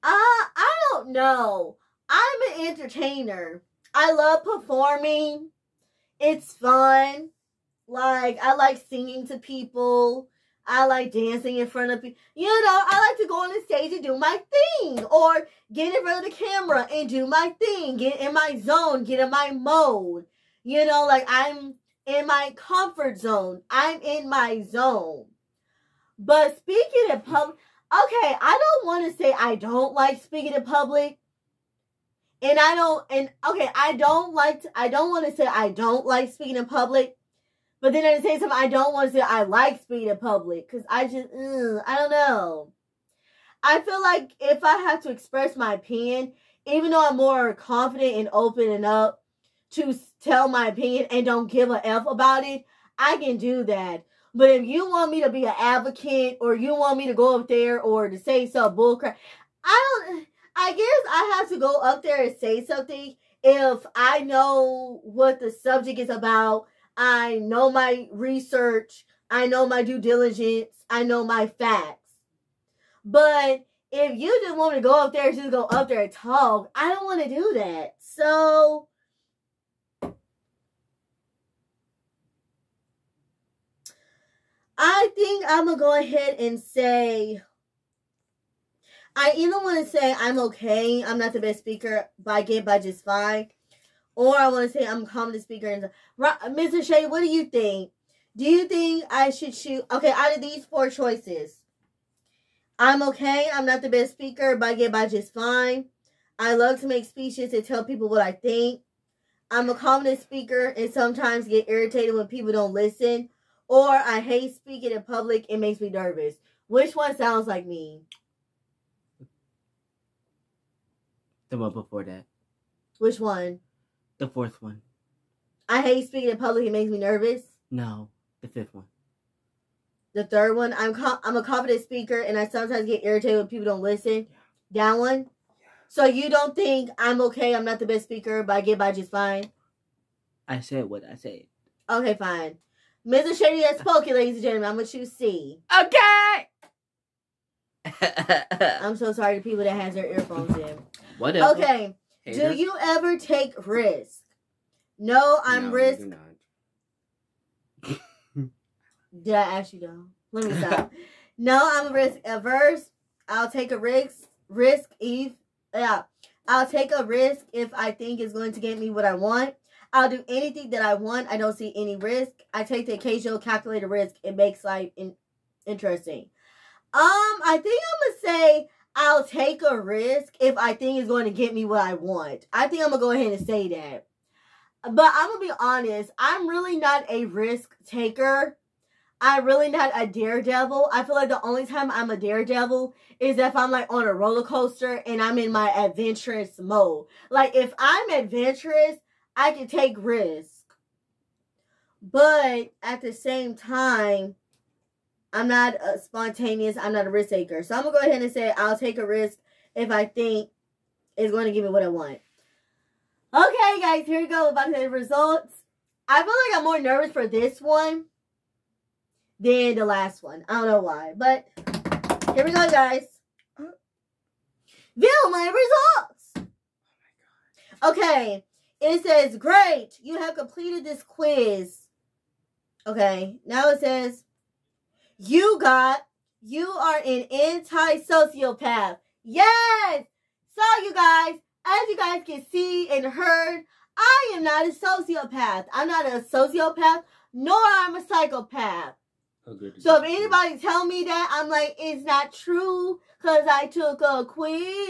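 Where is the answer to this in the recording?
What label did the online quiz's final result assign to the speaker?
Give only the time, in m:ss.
3:57.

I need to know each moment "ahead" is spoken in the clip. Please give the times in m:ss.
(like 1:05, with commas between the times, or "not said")
1:25, 3:03, 3:28.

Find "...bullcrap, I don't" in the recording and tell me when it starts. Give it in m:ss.
0:58.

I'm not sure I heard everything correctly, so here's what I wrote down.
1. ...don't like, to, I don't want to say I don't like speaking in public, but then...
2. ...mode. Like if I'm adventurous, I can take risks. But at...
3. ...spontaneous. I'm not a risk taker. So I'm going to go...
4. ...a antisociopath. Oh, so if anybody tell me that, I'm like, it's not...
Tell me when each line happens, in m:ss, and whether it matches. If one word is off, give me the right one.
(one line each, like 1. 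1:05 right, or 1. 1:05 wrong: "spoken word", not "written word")
1. 0:33 right
2. 3:16 right
3. 3:25 right
4. 4:07 wrong: "psychopath", not "antisociopath".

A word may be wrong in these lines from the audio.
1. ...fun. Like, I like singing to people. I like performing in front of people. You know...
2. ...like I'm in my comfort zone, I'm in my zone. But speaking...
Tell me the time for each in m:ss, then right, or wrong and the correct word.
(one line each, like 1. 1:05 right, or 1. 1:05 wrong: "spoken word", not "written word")
1. 0:06 wrong: "dancing", not "performing"
2. 0:21 right.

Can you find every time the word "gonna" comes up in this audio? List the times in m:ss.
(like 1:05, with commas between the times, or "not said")
2:24, 2:58.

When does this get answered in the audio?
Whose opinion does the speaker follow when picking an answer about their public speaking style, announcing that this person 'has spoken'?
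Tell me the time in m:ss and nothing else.
2:23.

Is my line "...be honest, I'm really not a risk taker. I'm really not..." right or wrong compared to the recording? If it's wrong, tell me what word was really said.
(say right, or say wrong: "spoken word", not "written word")
right.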